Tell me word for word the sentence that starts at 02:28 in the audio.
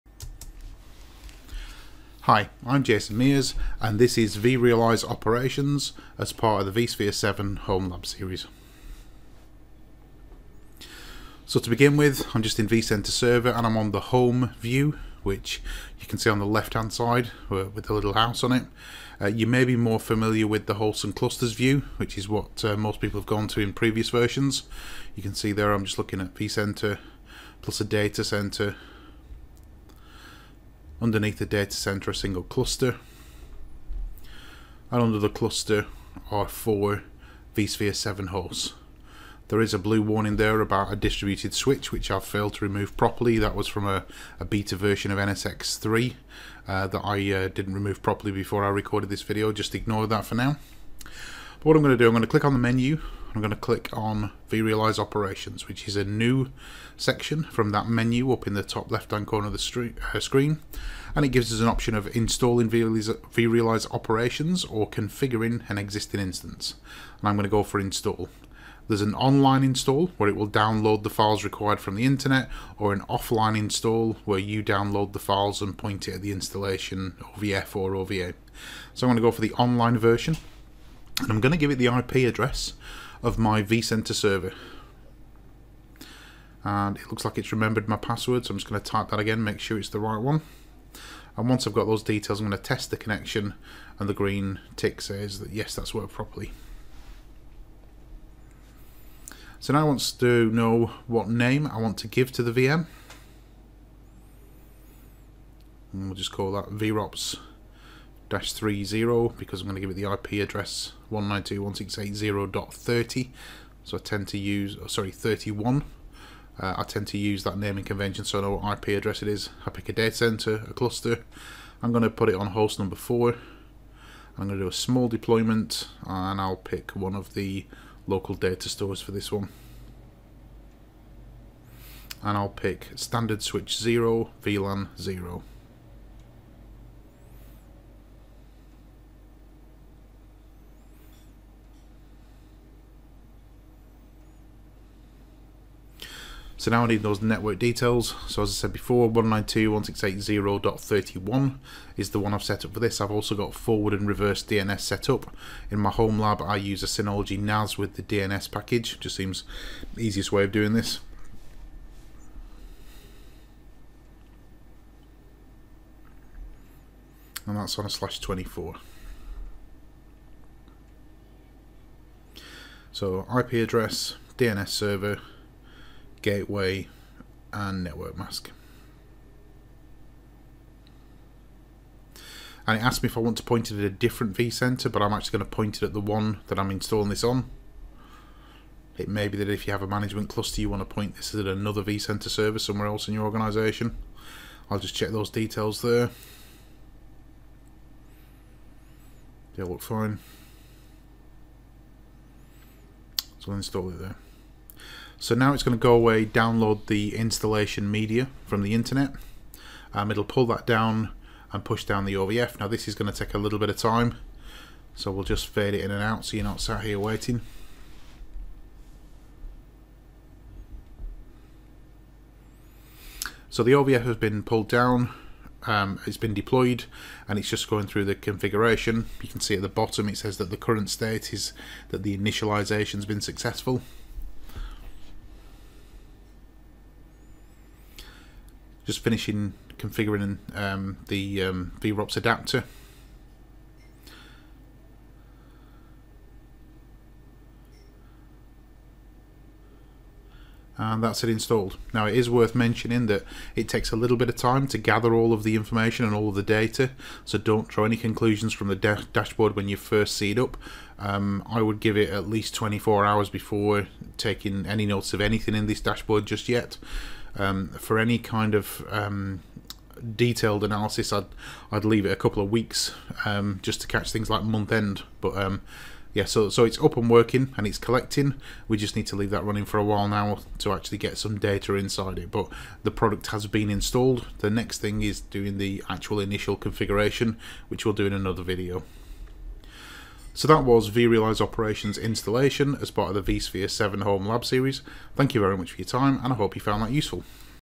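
So as I said before, 192.168.0.31 is the one I've set up for this.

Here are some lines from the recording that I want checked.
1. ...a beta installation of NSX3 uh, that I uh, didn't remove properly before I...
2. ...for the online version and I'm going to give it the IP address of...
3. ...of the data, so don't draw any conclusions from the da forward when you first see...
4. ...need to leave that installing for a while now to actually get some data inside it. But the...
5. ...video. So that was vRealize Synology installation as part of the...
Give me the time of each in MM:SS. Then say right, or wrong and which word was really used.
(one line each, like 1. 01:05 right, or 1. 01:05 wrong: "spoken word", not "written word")
1. 00:44 wrong: "version", not "installation"
2. 01:19 right
3. 04:16 wrong: "dashboard", not "forward"
4. 04:38 wrong: "running", not "installing"
5. 04:48 wrong: "Operations", not "Synology".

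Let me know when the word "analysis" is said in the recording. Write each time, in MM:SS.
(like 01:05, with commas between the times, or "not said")
04:30.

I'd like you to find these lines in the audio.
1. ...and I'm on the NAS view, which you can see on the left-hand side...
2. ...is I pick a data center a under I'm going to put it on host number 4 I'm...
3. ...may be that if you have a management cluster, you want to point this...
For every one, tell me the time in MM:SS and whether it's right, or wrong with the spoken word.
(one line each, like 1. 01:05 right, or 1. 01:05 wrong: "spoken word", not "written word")
1. 00:13 wrong: "Home", not "NAS"
2. 01:59 wrong: "cluster", not "under"
3. 03:09 right.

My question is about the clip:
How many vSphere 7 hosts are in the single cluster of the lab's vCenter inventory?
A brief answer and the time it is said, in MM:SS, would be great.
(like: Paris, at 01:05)
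4, at 00:36.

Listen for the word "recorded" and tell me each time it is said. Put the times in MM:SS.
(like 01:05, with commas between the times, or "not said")
00:48.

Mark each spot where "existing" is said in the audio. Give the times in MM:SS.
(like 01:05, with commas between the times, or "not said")
01:05.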